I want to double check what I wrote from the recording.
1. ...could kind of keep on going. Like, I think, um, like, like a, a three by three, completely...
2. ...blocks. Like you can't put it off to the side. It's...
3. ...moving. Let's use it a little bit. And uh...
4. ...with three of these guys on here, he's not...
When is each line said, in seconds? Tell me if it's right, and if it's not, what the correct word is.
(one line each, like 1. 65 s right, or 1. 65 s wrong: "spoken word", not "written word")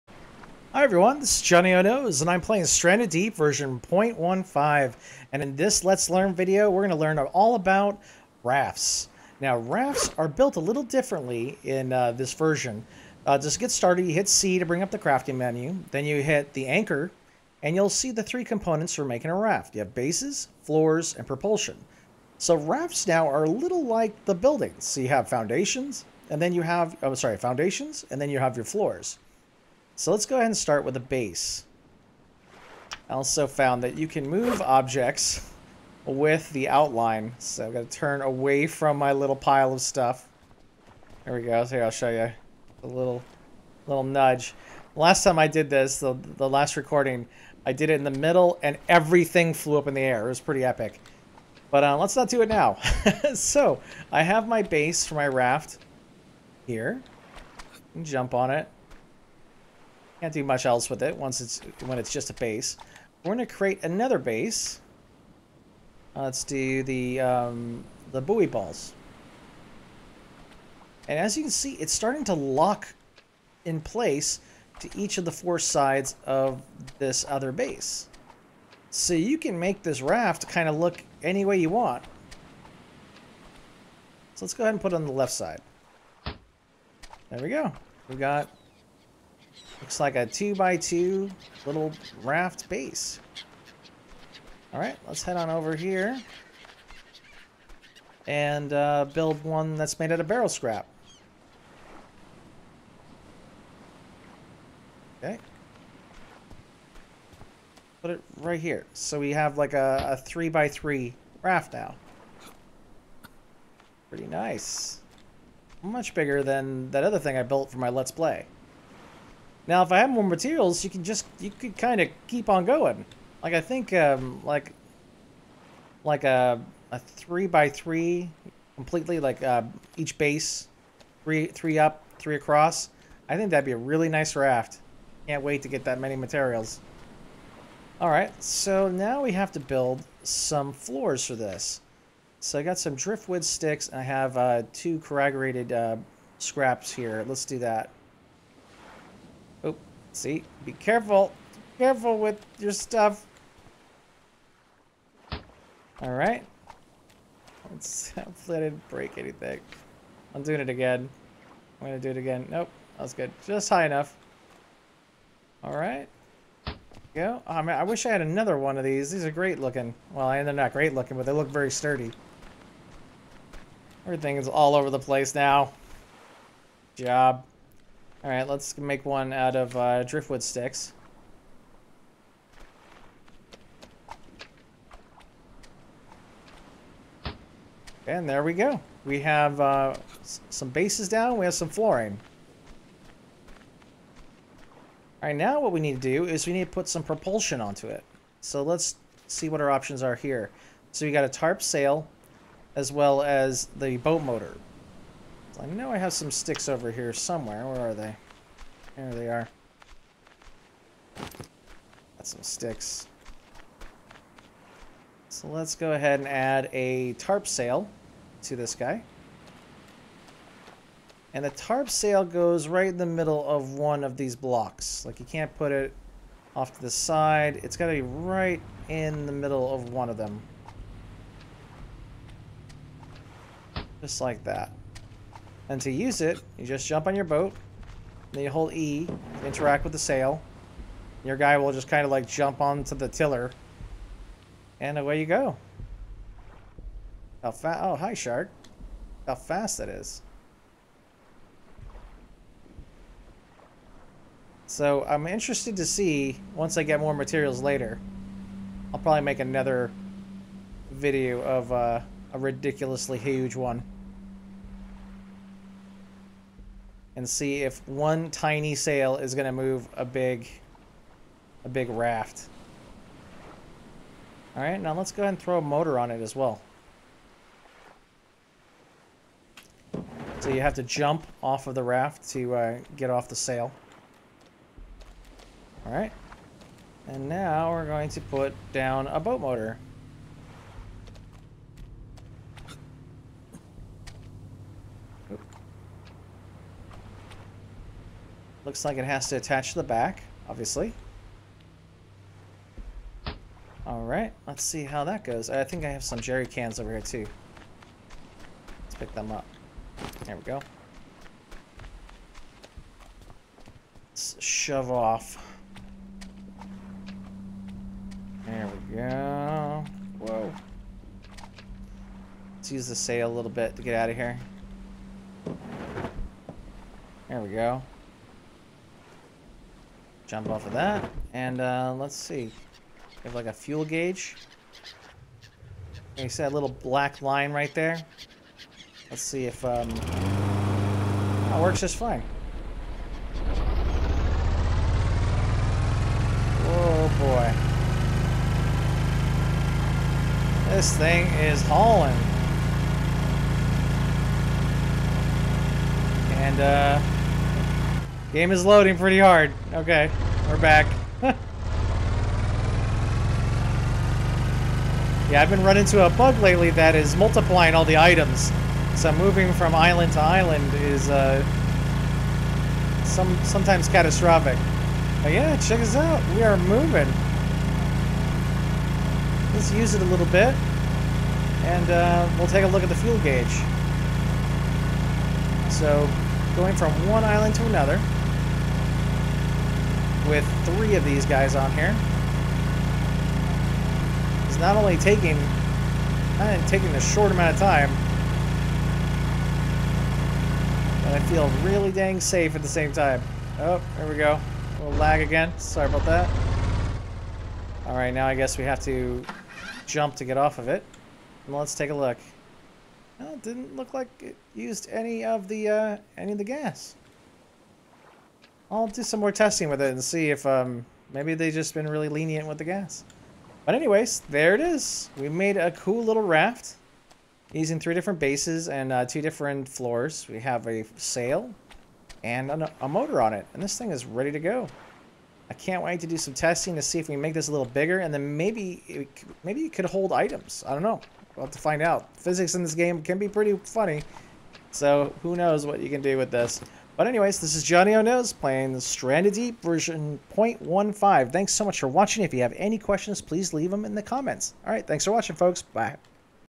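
1. 121 s right
2. 224 s right
3. 376 s right
4. 390 s right.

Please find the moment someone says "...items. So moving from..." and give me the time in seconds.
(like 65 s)
367 s.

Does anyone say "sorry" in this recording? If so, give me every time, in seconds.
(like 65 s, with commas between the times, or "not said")
27 s, 405 s.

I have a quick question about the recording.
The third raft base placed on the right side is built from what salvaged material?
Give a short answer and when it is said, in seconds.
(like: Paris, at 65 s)
barrel scrap, at 100 s.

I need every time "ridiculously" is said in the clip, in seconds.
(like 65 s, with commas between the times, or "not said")
262 s.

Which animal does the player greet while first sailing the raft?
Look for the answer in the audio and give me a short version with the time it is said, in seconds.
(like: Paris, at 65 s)
shark, at 248 s.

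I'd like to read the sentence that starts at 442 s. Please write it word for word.
Physics in this game can be pretty funny.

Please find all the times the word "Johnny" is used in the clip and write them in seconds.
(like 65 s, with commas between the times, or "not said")
1 s, 447 s.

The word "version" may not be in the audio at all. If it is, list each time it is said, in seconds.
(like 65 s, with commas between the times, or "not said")
3 s, 12 s, 449 s.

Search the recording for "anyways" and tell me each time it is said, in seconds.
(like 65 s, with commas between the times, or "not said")
423 s, 447 s.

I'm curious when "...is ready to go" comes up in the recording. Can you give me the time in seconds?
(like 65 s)
433 s.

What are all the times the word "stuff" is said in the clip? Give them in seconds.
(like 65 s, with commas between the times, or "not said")
39 s, 152 s.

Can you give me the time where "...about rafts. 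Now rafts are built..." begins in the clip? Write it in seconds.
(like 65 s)
7 s.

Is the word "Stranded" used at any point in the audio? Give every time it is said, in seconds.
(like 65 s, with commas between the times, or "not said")
2 s, 448 s.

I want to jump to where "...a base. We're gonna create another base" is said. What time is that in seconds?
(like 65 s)
62 s.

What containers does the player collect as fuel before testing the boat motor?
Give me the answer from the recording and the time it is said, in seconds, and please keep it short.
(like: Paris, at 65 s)
jerry cans, at 306 s.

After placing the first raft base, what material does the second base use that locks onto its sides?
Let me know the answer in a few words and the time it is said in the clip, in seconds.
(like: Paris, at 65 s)
buoy balls, at 68 s.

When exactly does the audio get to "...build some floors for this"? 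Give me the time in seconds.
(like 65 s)
139 s.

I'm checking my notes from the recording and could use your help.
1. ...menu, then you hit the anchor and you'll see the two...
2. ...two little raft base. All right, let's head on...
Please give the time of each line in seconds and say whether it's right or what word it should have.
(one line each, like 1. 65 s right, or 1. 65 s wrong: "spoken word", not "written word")
1. 15 s wrong: "three", not "two"
2. 90 s right.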